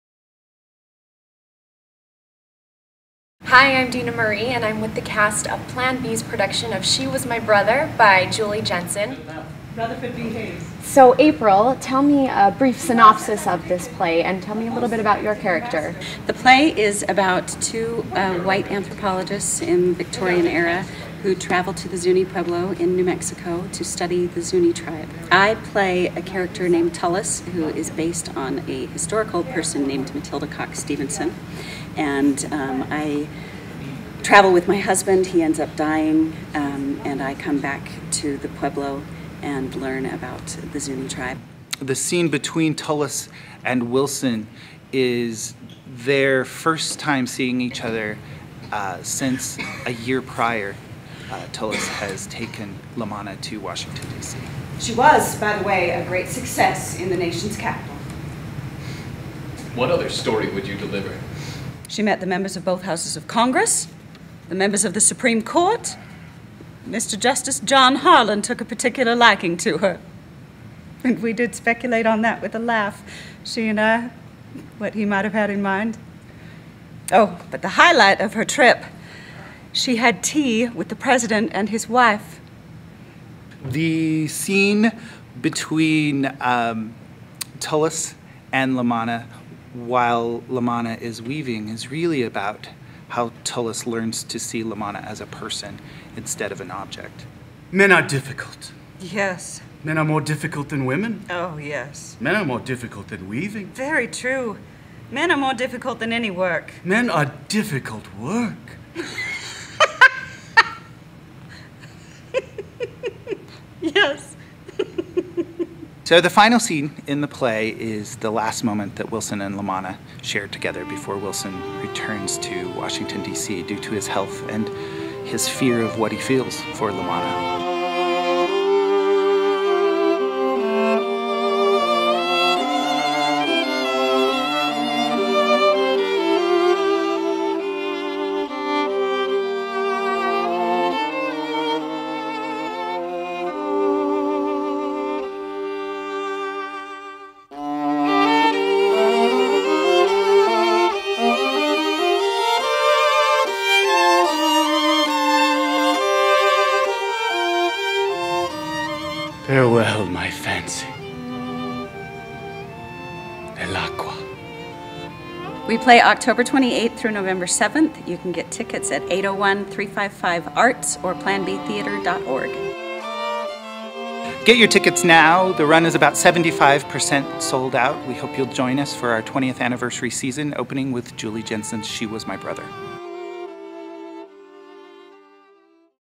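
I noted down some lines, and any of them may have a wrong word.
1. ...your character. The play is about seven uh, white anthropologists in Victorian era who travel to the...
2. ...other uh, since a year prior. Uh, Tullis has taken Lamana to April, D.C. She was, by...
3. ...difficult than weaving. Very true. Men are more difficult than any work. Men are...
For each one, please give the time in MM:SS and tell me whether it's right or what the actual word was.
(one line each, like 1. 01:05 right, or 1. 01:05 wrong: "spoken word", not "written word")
1. 00:15 wrong: "two", not "seven"
2. 00:47 wrong: "Washington", not "April"
3. 01:42 right.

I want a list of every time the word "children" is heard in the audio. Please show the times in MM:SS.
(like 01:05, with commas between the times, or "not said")
not said.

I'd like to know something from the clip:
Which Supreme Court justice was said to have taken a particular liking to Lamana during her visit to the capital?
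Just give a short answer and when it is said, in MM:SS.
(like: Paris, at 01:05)
John Harlan, at 01:07.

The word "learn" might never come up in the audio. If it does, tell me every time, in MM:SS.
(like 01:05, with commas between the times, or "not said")
00:39, 01:33.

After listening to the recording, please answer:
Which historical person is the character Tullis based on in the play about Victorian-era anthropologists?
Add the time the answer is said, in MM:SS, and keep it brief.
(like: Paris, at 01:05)
Matilda Coxe Stevenson, at 00:30.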